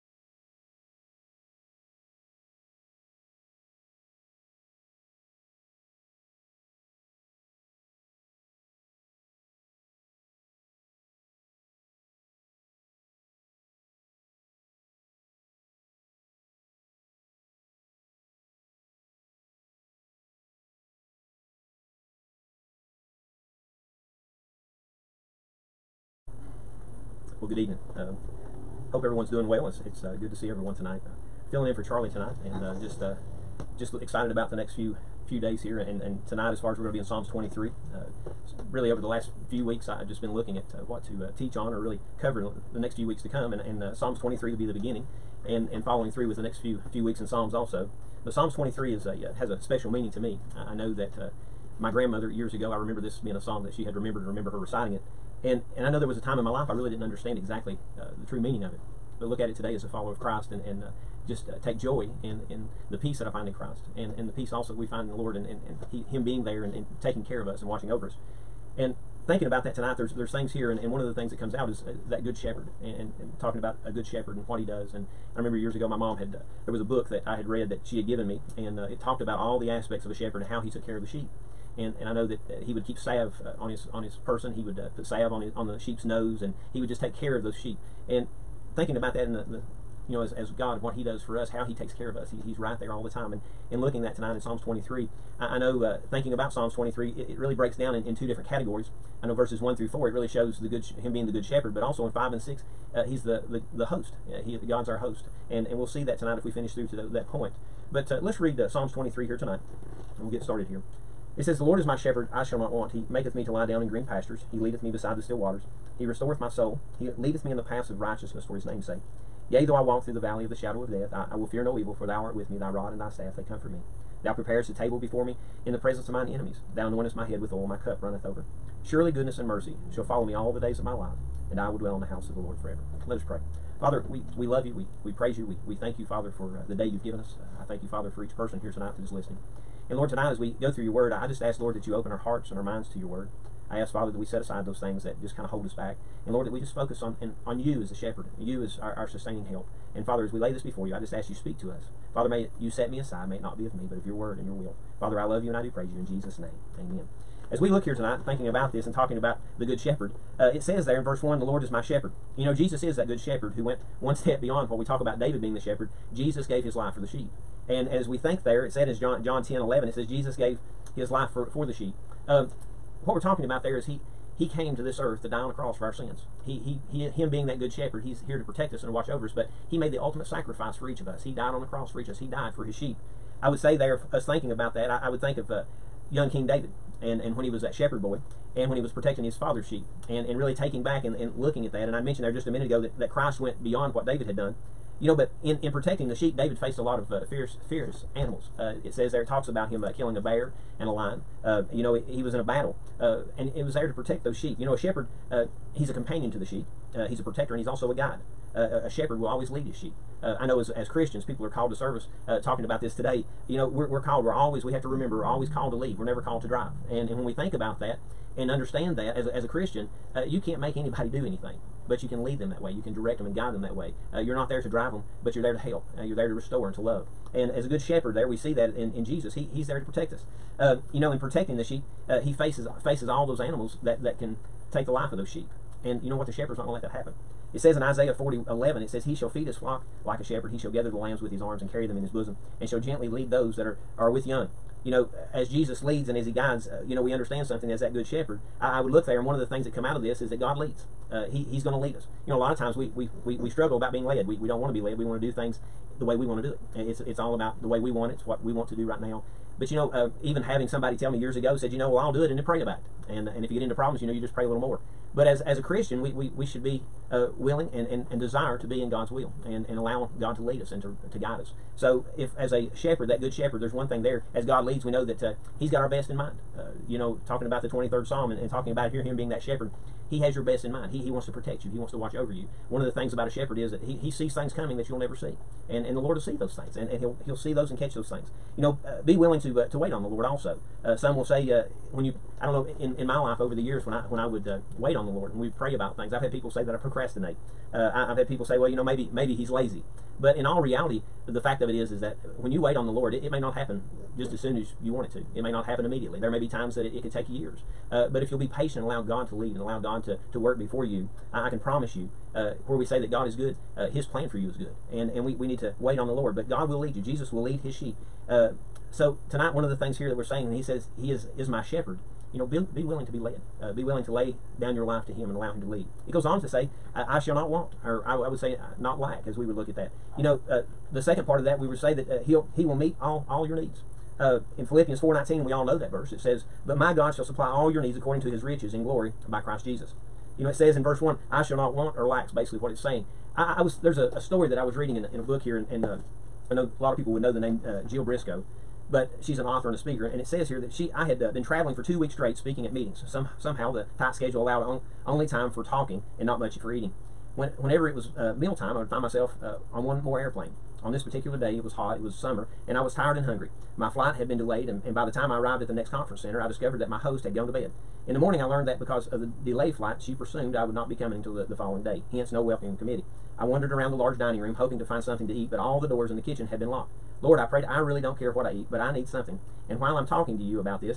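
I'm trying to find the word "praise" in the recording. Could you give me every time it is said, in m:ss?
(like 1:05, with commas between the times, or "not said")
2:15, 2:35.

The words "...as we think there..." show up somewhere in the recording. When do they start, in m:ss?
2:47.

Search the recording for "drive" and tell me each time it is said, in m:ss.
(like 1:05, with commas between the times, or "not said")
3:36, 3:44.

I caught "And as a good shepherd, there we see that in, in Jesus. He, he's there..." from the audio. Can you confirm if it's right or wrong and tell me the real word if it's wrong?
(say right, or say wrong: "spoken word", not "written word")
right.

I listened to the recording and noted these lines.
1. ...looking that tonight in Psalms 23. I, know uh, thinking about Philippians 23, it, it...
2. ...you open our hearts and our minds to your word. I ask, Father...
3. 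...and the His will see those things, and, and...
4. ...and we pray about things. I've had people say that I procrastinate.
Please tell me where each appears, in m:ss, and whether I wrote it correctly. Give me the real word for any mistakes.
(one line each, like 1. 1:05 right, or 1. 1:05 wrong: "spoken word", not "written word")
1. 1:33 wrong: "Psalms", not "Philippians"
2. 2:21 right
3. 4:45 wrong: "Lord", not "His"
4. 4:55 right.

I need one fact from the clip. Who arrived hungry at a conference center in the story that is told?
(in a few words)
Jill Briscoe.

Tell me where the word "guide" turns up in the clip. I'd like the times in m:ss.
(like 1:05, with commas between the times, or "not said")
3:27, 3:43, 4:06, 4:31.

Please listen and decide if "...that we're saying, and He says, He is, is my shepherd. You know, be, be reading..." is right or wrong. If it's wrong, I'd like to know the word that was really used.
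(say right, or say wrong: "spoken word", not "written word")
wrong: "willing", not "reading".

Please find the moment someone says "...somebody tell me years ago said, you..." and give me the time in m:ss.
4:20.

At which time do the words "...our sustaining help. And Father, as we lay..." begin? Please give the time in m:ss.
2:28.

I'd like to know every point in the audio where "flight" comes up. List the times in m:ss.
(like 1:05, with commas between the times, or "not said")
6:03, 6:09.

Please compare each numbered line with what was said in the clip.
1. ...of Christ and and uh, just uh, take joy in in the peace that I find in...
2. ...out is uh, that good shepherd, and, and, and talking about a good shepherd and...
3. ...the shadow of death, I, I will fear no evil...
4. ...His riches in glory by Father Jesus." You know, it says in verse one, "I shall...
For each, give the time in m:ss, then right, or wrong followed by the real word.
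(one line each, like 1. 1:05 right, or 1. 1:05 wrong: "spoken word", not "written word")
1. 1:00 right
2. 1:11 right
3. 2:00 right
4. 5:38 wrong: "Christ", not "Father".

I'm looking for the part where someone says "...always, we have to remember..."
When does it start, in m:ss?
3:34.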